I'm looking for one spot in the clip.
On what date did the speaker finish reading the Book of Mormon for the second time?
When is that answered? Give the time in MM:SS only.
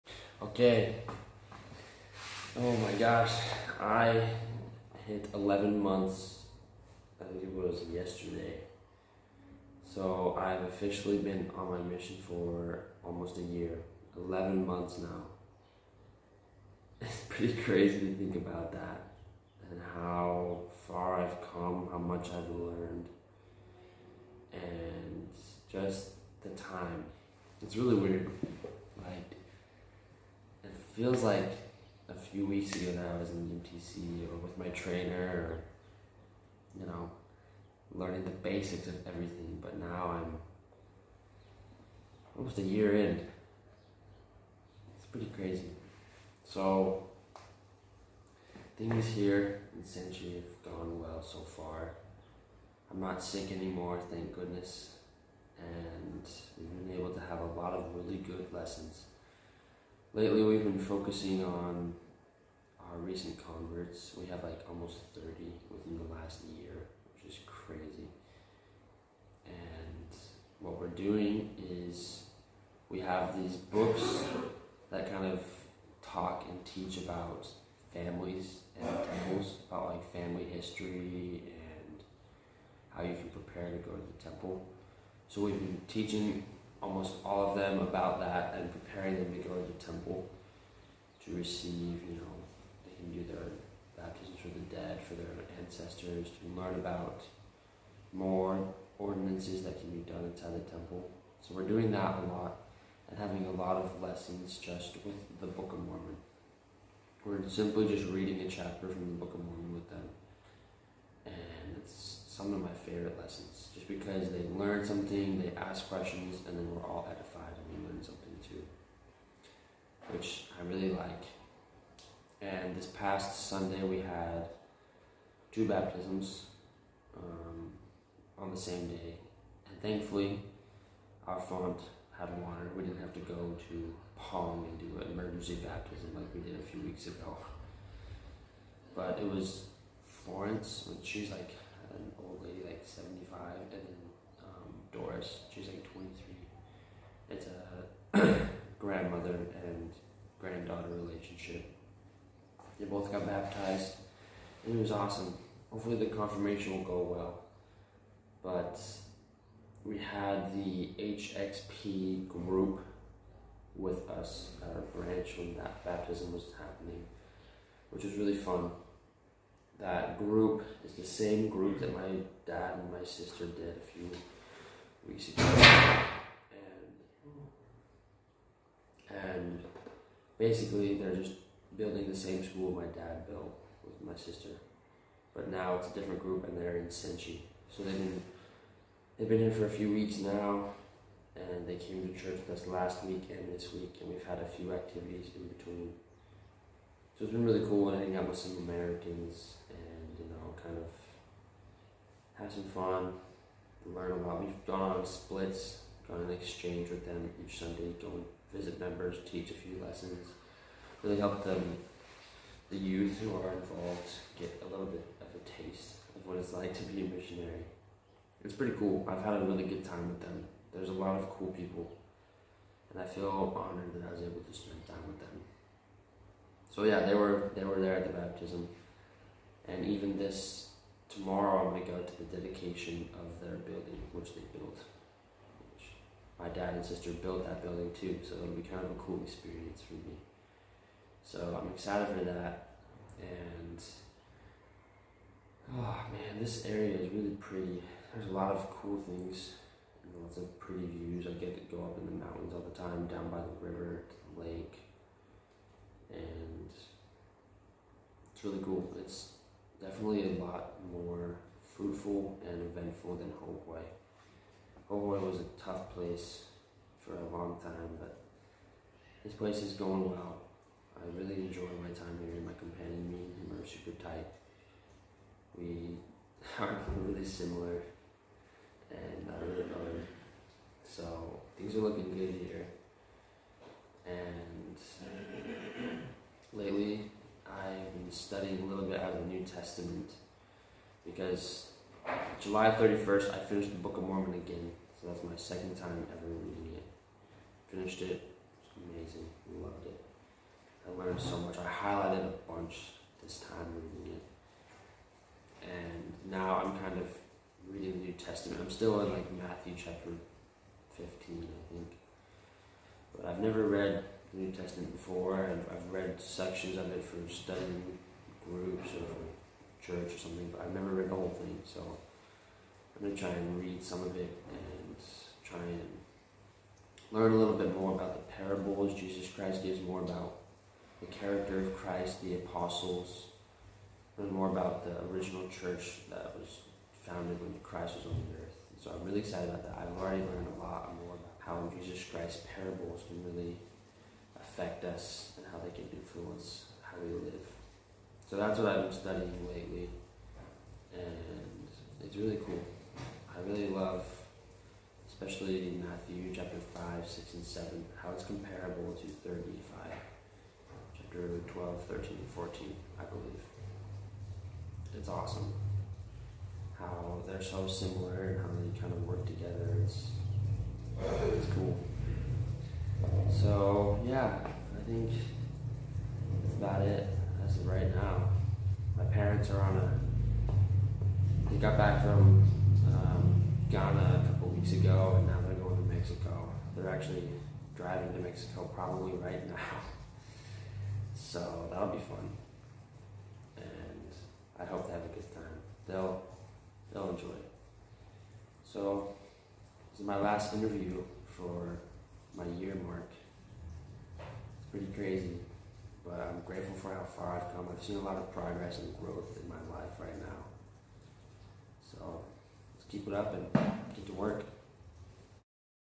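04:52.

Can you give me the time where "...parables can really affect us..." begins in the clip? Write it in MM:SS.
05:42.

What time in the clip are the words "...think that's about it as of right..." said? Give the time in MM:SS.
06:14.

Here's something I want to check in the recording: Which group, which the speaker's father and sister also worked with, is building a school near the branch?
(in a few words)
HXP.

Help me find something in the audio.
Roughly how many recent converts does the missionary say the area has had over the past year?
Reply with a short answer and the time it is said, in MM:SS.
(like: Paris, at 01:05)
30, at 01:04.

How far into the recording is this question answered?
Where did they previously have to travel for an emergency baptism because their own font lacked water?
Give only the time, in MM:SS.
02:14.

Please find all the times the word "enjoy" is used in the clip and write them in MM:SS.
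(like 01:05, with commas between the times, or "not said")
04:31, 06:37.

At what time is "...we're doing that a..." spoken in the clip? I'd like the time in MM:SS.
01:41.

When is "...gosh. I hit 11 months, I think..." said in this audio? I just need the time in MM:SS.
00:02.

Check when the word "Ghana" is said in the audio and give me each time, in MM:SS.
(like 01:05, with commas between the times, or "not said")
06:23.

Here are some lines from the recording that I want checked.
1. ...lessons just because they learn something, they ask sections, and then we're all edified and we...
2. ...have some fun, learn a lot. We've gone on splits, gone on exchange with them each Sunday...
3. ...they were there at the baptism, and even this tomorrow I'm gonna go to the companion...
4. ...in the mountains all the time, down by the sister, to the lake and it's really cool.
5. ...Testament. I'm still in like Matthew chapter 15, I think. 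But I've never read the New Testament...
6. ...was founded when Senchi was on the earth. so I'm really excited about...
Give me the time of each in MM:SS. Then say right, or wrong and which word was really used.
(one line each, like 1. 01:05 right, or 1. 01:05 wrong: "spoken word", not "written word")
1. 01:53 wrong: "questions", not "sections"
2. 03:22 right
3. 03:47 wrong: "dedication", not "companion"
4. 04:11 wrong: "river", not "sister"
5. 05:08 right
6. 05:36 wrong: "Christ", not "Senchi".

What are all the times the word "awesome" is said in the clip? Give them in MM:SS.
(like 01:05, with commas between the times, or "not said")
02:34, 06:05.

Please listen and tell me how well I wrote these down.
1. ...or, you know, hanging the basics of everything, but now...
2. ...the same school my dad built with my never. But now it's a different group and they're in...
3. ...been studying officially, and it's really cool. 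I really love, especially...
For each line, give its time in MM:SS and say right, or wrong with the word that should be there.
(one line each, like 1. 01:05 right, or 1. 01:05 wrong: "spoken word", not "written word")
1. 00:35 wrong: "learning", not "hanging"
2. 03:02 wrong: "sister", not "never"
3. 05:48 wrong: "lately", not "officially".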